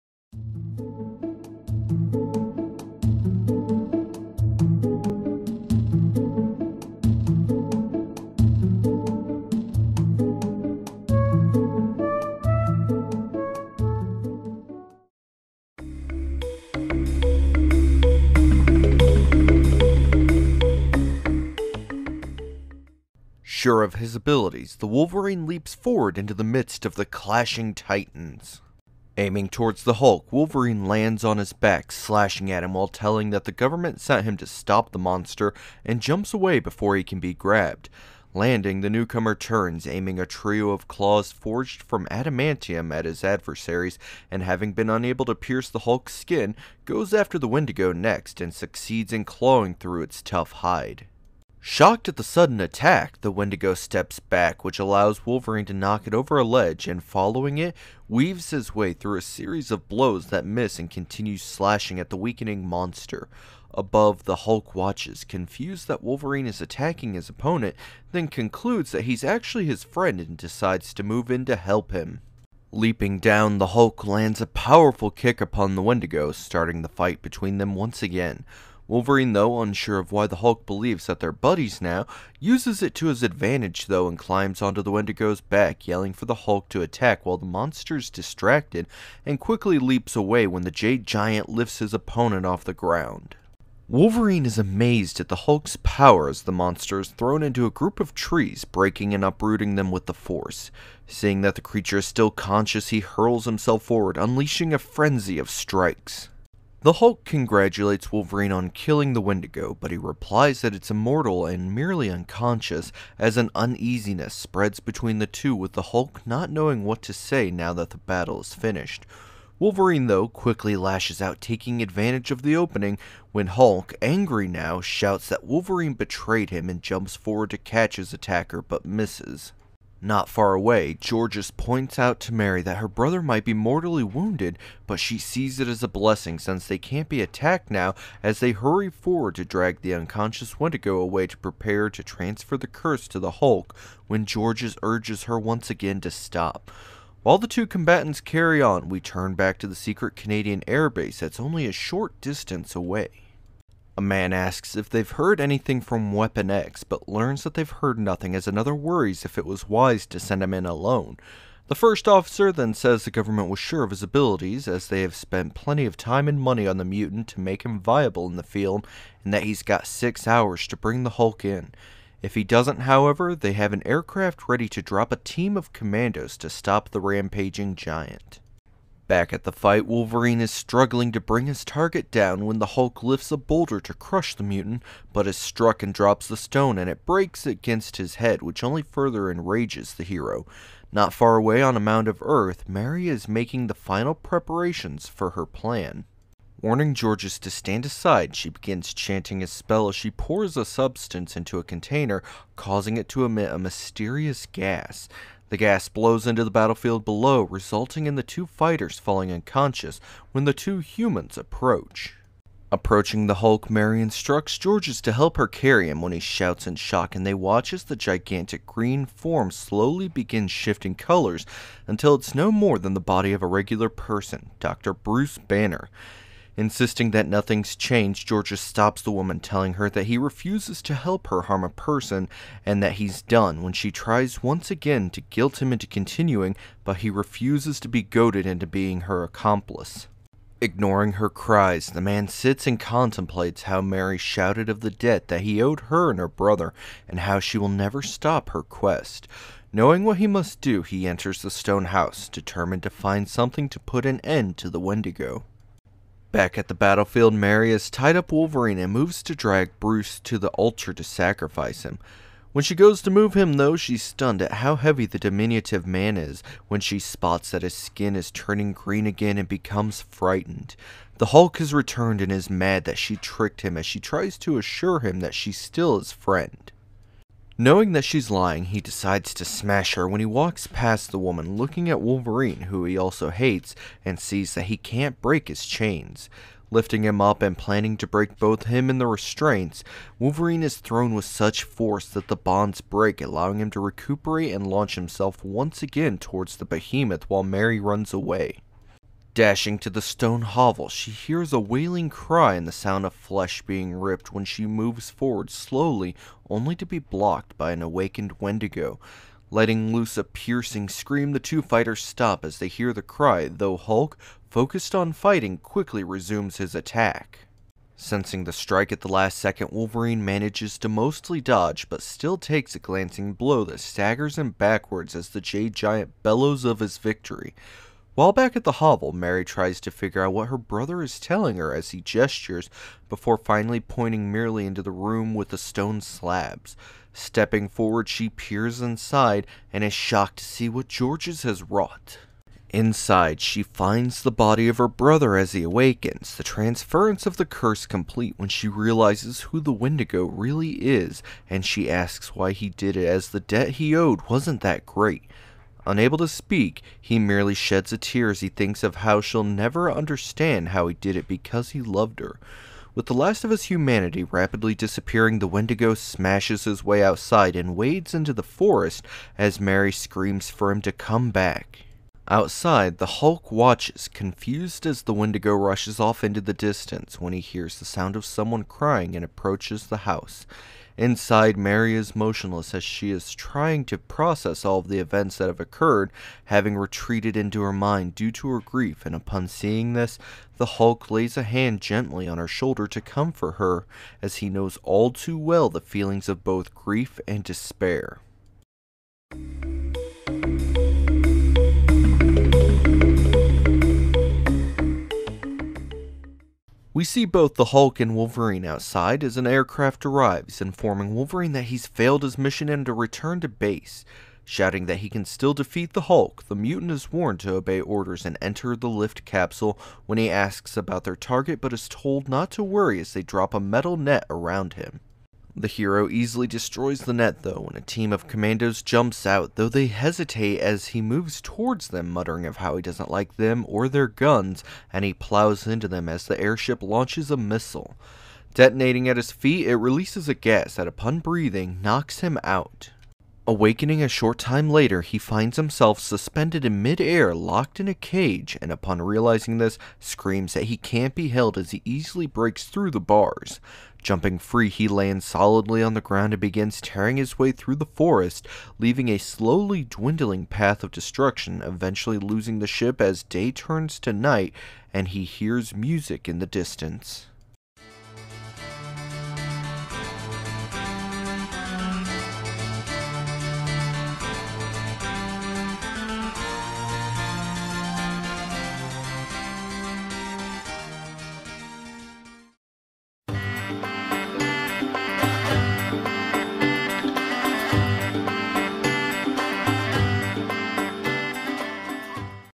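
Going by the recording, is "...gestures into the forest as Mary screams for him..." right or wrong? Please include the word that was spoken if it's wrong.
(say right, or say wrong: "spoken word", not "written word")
wrong: "wades", not "gestures".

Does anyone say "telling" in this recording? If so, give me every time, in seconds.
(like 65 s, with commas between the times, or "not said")
32 s, 229 s, 331 s.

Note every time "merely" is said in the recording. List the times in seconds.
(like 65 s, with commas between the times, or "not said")
111 s, 334 s, 357 s.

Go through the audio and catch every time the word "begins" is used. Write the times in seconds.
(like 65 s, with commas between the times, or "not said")
198 s, 220 s, 456 s.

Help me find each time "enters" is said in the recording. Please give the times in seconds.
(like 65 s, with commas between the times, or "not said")
251 s, 418 s.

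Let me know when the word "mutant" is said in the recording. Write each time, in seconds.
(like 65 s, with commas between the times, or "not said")
166 s, 184 s, 416 s.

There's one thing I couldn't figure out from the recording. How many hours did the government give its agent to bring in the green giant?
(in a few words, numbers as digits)
6.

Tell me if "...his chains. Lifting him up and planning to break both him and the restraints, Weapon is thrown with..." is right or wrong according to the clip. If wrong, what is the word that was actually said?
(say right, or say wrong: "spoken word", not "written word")
wrong: "Wolverine", not "Weapon".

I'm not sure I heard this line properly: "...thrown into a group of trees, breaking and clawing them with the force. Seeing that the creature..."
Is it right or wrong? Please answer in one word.
wrong.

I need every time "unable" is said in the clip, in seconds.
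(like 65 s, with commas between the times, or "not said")
44 s, 355 s.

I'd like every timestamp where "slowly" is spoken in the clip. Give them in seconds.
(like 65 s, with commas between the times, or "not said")
219 s, 305 s, 459 s.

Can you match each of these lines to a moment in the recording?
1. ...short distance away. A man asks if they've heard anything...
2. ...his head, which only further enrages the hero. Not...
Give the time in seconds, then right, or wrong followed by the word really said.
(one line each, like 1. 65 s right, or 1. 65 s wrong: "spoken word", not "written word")
1. 151 s right
2. 187 s right.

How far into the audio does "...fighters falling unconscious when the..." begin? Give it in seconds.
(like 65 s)
208 s.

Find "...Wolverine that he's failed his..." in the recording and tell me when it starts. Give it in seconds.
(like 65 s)
411 s.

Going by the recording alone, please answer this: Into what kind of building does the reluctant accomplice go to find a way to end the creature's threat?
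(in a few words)
Stone house.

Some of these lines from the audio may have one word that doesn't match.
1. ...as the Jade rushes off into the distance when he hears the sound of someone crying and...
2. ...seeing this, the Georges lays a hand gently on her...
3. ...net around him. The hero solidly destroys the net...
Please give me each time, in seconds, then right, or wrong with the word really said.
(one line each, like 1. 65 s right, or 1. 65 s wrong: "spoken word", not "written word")
1. 374 s wrong: "Wendigo", not "Jade"
2. 389 s wrong: "Hulk", not "Georges"
3. 423 s wrong: "easily", not "solidly".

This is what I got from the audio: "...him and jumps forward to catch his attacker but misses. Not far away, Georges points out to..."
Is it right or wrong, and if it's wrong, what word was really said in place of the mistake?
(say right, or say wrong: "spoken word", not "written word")
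right.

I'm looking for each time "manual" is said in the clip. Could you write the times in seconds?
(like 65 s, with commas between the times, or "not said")
not said.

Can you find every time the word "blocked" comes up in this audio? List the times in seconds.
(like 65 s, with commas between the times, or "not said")
306 s.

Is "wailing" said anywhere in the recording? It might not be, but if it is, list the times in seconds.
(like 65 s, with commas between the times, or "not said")
301 s.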